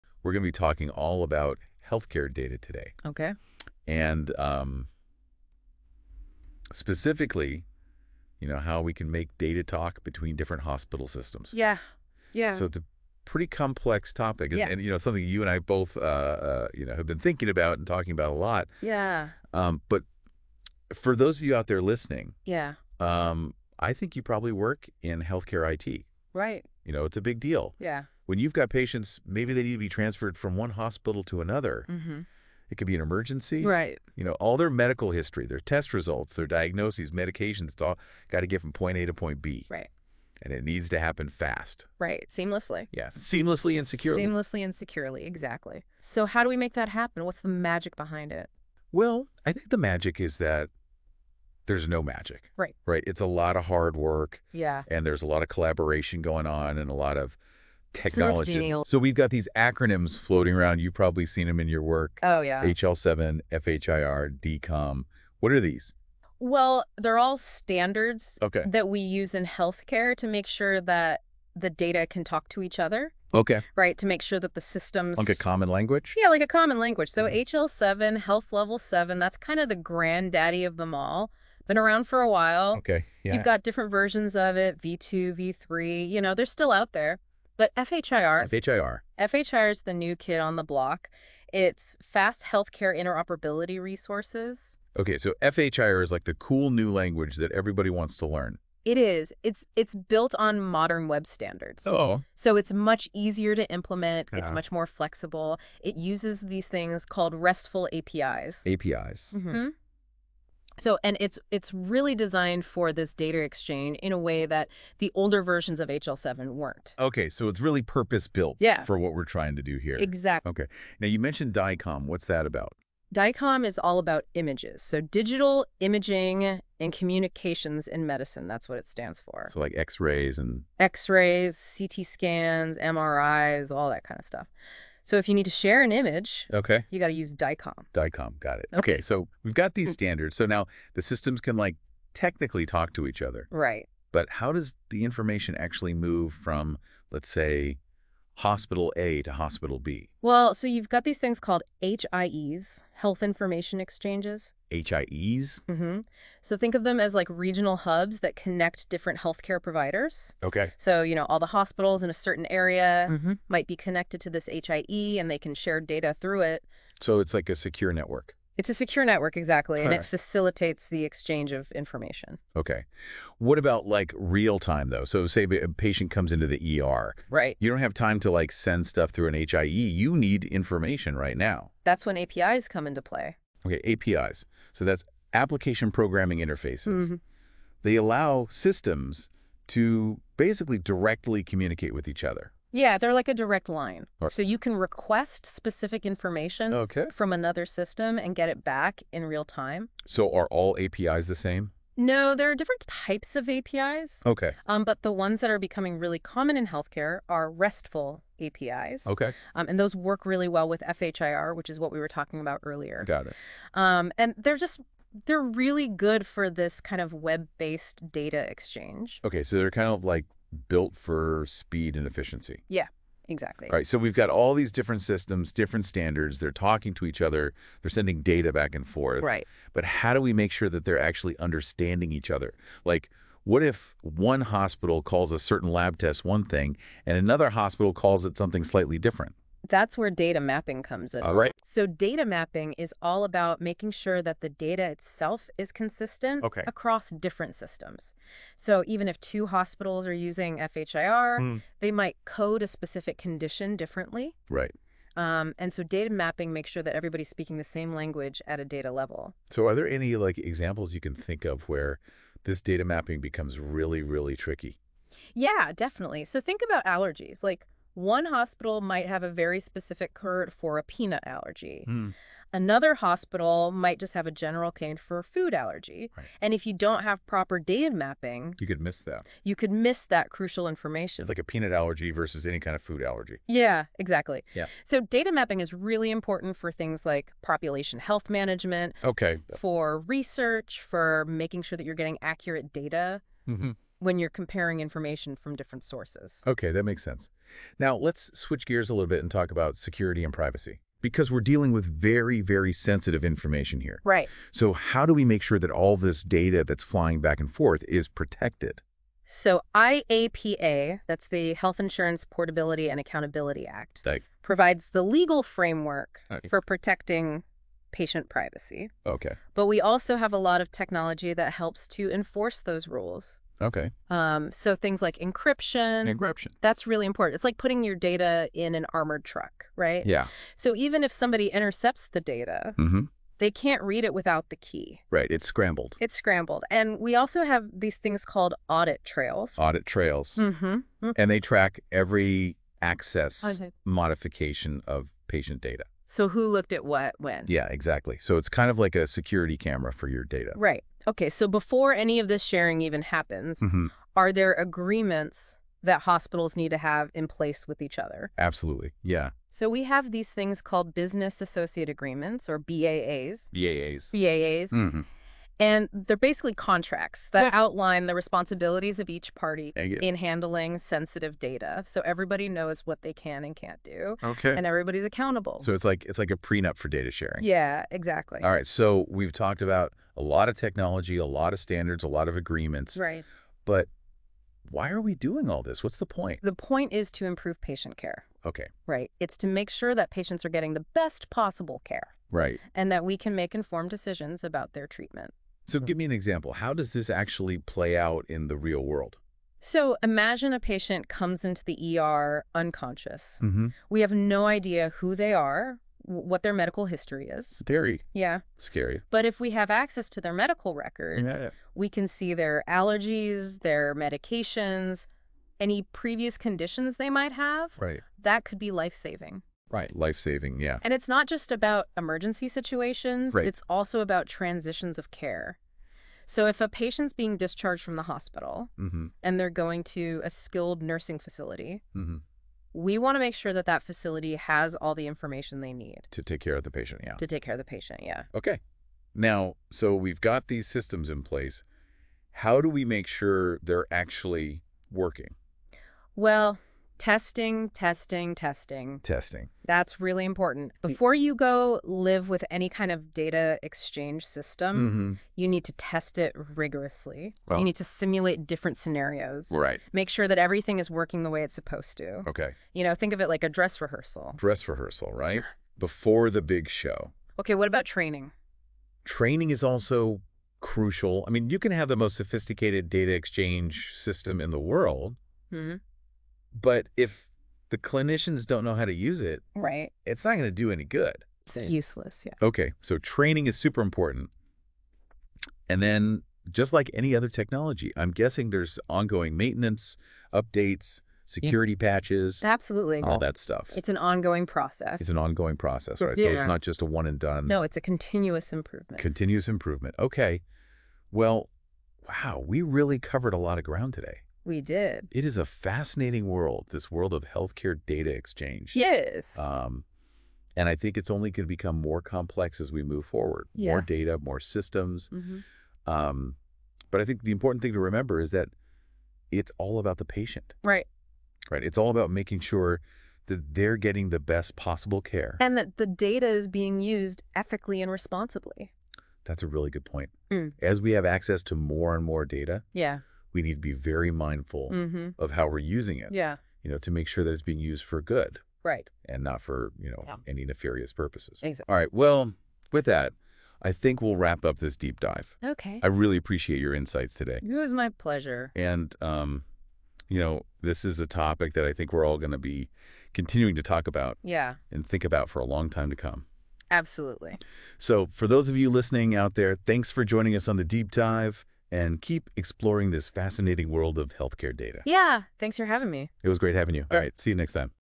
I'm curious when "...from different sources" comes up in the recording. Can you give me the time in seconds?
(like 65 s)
295 s.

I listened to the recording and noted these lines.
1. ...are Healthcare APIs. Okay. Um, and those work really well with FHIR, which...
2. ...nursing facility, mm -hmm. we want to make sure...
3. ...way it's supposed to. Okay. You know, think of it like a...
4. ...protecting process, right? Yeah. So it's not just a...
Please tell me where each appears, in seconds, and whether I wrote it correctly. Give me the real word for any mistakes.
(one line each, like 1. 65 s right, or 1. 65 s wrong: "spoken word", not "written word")
1. 207 s wrong: "RESTful", not "Healthcare"
2. 430 s right
3. 461 s right
4. 495 s wrong: "ongoing", not "protecting".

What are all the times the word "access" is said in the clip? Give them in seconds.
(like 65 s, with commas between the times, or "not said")
342 s, 409 s, 531 s.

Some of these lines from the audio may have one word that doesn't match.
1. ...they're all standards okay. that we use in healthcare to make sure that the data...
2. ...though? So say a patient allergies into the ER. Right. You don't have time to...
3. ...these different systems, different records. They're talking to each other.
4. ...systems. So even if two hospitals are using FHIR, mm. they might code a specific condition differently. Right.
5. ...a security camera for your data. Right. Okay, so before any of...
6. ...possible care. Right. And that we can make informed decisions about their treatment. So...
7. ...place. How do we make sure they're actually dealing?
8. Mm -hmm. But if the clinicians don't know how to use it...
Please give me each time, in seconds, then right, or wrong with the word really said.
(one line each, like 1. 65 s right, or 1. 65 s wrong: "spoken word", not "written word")
1. 66 s right
2. 174 s wrong: "comes", not "allergies"
3. 224 s wrong: "standards", not "records"
4. 247 s right
5. 349 s right
6. 391 s right
7. 441 s wrong: "working", not "dealing"
8. 475 s right.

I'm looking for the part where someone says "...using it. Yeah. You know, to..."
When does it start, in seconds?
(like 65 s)
535 s.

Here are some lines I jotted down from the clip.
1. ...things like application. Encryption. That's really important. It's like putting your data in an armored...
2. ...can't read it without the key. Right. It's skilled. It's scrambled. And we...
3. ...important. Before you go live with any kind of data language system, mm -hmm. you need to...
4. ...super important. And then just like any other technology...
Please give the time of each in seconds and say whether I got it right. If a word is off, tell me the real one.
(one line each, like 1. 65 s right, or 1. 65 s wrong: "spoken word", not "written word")
1. 324 s wrong: "encryption", not "application"
2. 333 s wrong: "scrambled", not "skilled"
3. 450 s wrong: "exchange", not "language"
4. 483 s right.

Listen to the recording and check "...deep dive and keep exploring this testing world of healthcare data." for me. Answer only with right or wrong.
wrong.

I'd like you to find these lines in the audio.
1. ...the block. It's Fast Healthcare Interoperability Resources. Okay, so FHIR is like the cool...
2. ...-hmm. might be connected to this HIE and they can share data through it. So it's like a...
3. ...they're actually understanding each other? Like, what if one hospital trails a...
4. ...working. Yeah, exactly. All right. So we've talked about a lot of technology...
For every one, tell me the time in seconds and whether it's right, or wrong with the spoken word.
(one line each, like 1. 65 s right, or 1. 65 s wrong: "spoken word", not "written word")
1. 90 s right
2. 163 s right
3. 230 s wrong: "calls", not "trails"
4. 377 s wrong: "sharing", not "working".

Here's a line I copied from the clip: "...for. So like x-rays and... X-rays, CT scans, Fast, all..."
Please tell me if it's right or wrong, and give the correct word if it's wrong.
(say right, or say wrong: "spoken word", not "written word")
wrong: "MRIs", not "Fast".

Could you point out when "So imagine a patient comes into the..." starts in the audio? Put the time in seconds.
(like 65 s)
399 s.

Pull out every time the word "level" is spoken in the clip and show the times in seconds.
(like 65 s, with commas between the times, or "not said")
78 s, 258 s.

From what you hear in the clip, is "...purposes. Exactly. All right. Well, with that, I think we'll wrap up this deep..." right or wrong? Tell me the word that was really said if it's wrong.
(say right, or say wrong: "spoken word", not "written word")
right.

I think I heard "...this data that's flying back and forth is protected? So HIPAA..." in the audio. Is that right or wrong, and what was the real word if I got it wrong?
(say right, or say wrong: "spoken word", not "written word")
right.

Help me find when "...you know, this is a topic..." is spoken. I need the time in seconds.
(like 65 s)
550 s.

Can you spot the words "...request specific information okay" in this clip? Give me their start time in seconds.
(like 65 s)
194 s.